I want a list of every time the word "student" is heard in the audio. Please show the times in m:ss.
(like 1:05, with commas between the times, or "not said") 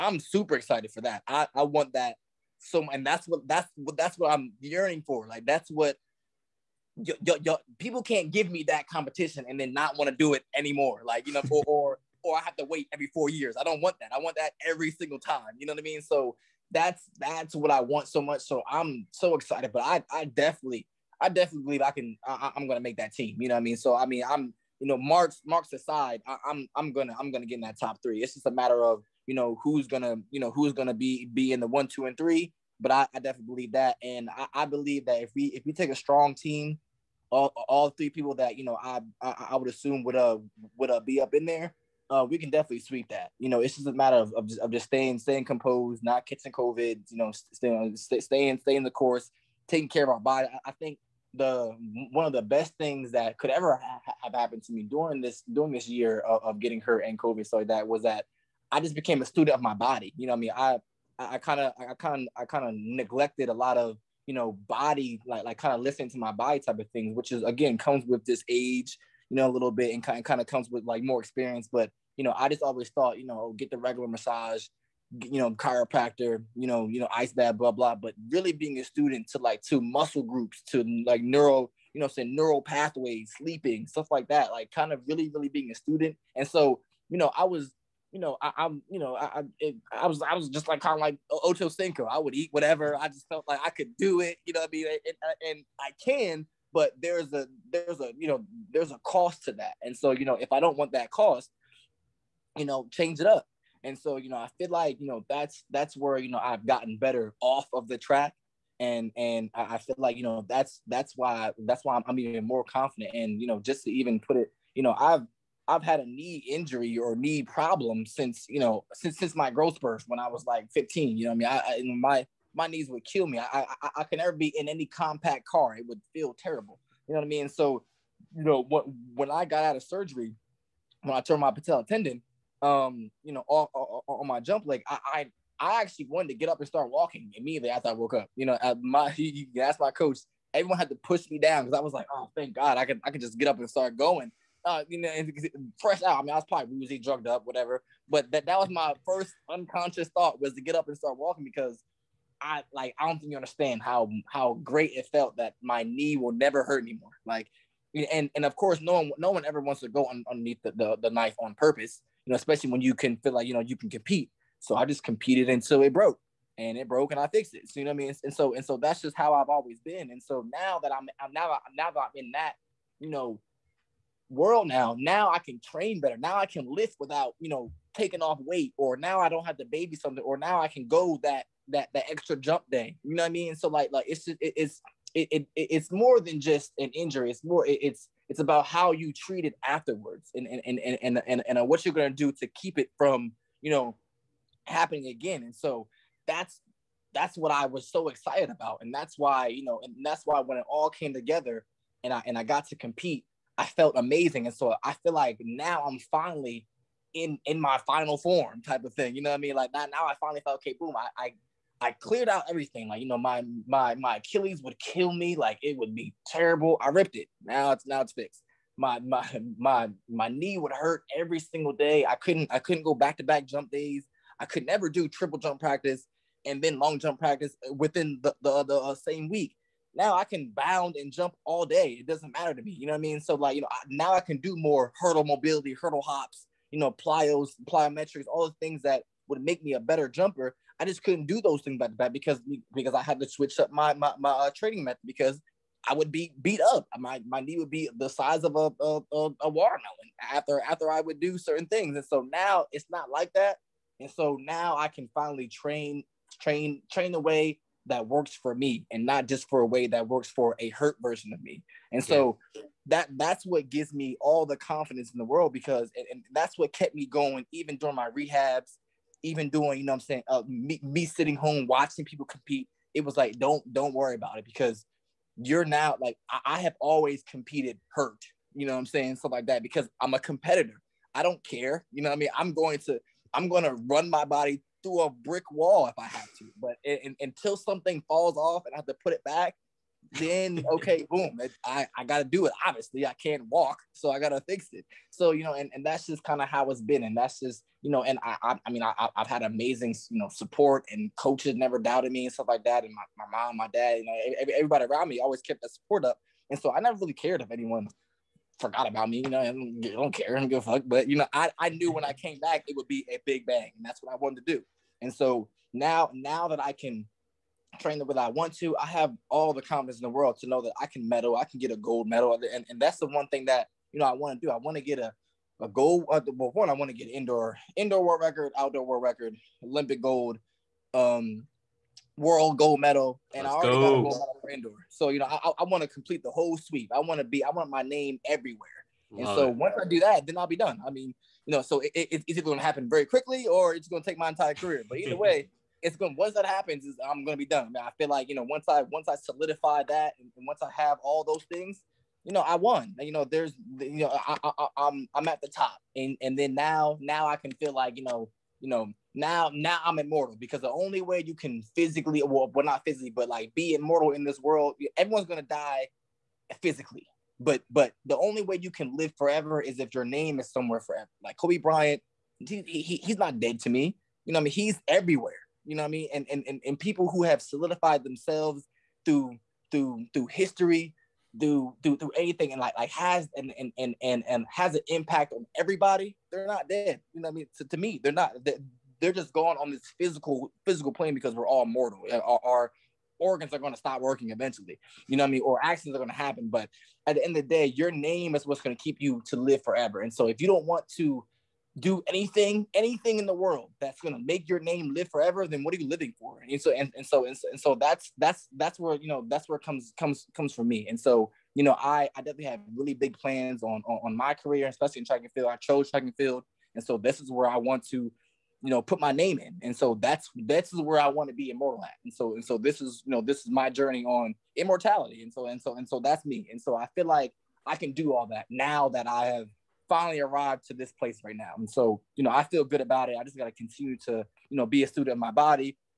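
0:59, 1:18, 1:25, 7:14.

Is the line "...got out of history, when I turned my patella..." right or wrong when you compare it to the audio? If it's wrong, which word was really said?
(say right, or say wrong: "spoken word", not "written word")
wrong: "surgery", not "history".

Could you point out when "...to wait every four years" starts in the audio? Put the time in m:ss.
0:12.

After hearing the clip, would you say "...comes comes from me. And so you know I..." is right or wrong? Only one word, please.
right.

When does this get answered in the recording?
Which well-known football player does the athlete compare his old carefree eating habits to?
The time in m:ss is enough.
1:31.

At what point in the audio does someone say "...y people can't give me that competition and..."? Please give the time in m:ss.
0:07.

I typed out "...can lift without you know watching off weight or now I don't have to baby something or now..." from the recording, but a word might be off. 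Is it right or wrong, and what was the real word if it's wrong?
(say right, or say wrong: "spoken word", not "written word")
wrong: "taking", not "watching".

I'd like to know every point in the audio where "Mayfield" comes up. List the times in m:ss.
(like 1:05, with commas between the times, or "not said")
not said.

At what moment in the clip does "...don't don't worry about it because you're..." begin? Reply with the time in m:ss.
4:33.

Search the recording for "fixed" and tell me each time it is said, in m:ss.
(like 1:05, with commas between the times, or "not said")
2:47, 3:38.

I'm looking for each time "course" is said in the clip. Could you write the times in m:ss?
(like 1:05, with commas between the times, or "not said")
0:48, 2:38.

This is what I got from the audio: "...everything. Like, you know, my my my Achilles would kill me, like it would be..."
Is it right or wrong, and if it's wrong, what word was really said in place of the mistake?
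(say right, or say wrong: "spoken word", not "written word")
right.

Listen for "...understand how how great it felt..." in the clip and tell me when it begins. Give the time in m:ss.
2:33.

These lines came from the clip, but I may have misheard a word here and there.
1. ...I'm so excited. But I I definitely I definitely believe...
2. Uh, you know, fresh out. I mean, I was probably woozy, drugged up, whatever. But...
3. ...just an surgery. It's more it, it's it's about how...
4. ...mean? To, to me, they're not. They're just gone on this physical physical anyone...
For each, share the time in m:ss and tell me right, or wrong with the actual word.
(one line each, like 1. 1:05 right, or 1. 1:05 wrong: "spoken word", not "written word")
1. 0:18 right
2. 2:24 right
3. 3:06 wrong: "injury", not "surgery"
4. 6:27 wrong: "plane", not "anyone".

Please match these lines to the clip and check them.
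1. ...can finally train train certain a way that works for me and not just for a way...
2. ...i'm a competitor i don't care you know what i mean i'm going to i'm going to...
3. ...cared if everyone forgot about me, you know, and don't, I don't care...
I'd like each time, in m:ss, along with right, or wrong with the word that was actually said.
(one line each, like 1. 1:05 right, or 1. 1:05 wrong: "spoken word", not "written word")
1. 4:14 wrong: "train", not "certain"
2. 4:40 right
3. 5:07 wrong: "anyone", not "everyone".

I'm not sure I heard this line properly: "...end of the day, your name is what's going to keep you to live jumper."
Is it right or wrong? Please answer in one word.
wrong.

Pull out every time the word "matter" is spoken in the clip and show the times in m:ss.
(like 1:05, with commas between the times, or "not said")
0:28, 0:43, 3:52.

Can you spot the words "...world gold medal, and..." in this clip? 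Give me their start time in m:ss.
5:32.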